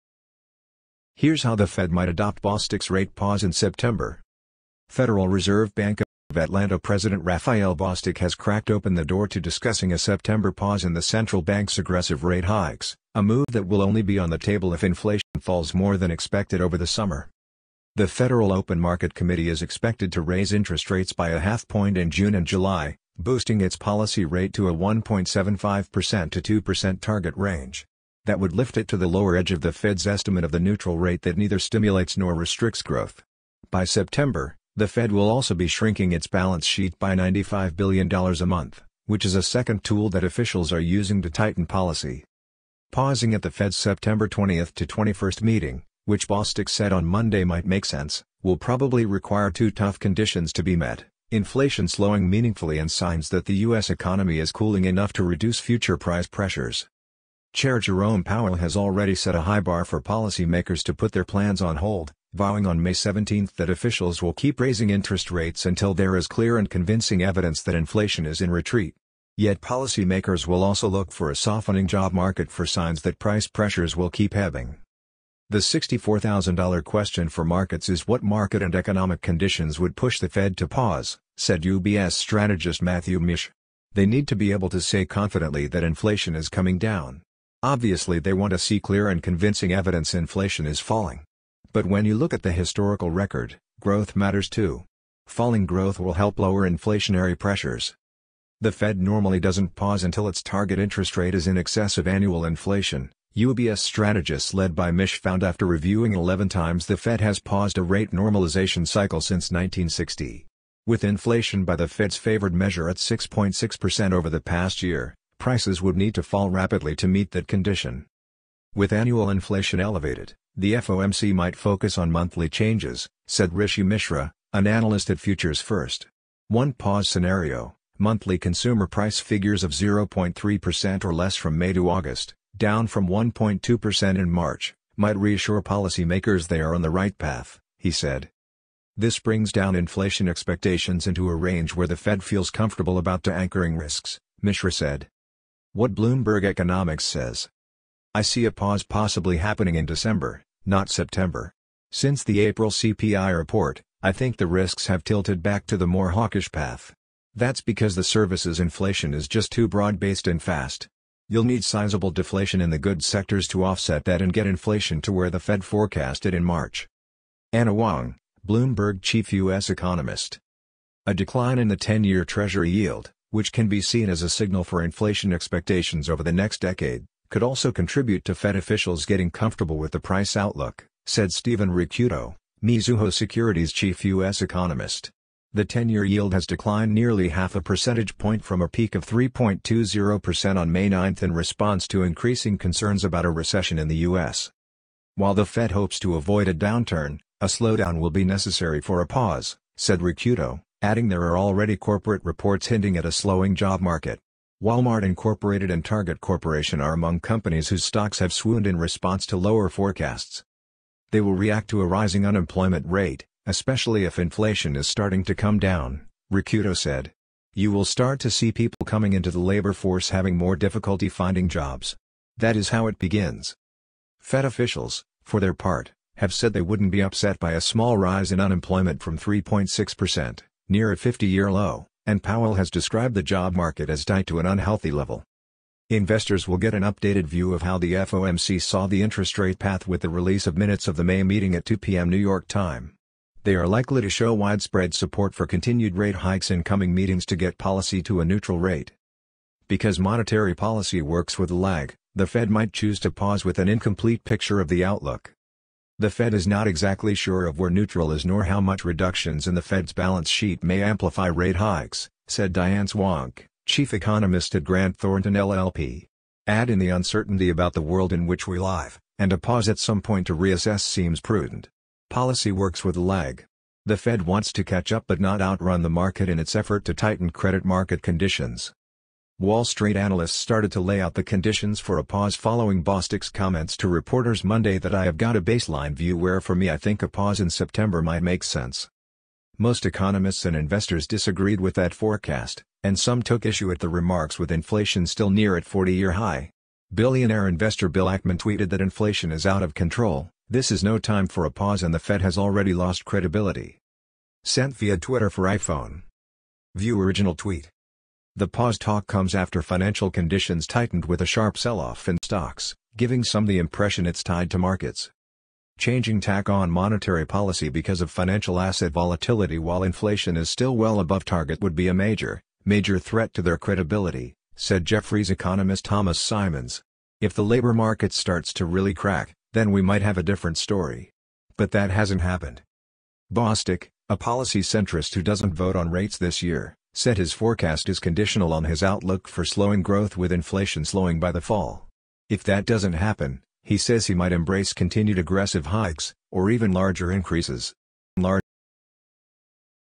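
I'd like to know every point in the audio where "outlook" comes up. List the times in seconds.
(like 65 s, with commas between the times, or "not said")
180 s, 254 s, 338 s.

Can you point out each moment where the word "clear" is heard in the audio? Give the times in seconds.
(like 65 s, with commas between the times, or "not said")
66 s, 88 s.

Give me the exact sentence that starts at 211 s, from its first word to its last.
They will react to a rising unemployment rate, especially if inflation is starting to come down, Ricciuto said.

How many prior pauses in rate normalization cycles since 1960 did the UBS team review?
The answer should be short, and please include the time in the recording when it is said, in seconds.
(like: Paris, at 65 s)
11, at 106 s.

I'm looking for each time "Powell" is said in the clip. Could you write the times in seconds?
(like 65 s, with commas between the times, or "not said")
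58 s, 232 s.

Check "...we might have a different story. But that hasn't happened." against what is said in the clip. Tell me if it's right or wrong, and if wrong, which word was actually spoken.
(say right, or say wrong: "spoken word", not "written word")
right.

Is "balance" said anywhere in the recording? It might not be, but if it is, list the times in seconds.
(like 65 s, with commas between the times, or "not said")
36 s, 259 s.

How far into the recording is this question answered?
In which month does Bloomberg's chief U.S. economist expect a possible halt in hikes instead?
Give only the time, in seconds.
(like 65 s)
149 s.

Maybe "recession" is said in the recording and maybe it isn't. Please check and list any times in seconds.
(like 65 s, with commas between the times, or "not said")
193 s.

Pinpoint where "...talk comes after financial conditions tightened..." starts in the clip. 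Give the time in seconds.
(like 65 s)
308 s.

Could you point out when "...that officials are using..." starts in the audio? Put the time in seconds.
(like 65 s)
40 s.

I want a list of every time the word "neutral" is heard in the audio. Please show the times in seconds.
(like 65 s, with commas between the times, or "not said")
30 s, 248 s, 257 s.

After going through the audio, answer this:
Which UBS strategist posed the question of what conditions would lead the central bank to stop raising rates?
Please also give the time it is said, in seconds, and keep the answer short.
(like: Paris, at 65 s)
Matthew Mish, at 82 s.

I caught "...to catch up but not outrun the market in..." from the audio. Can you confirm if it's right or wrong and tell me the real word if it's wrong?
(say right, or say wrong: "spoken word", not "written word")
right.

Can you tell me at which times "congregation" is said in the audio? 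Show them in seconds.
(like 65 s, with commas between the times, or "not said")
not said.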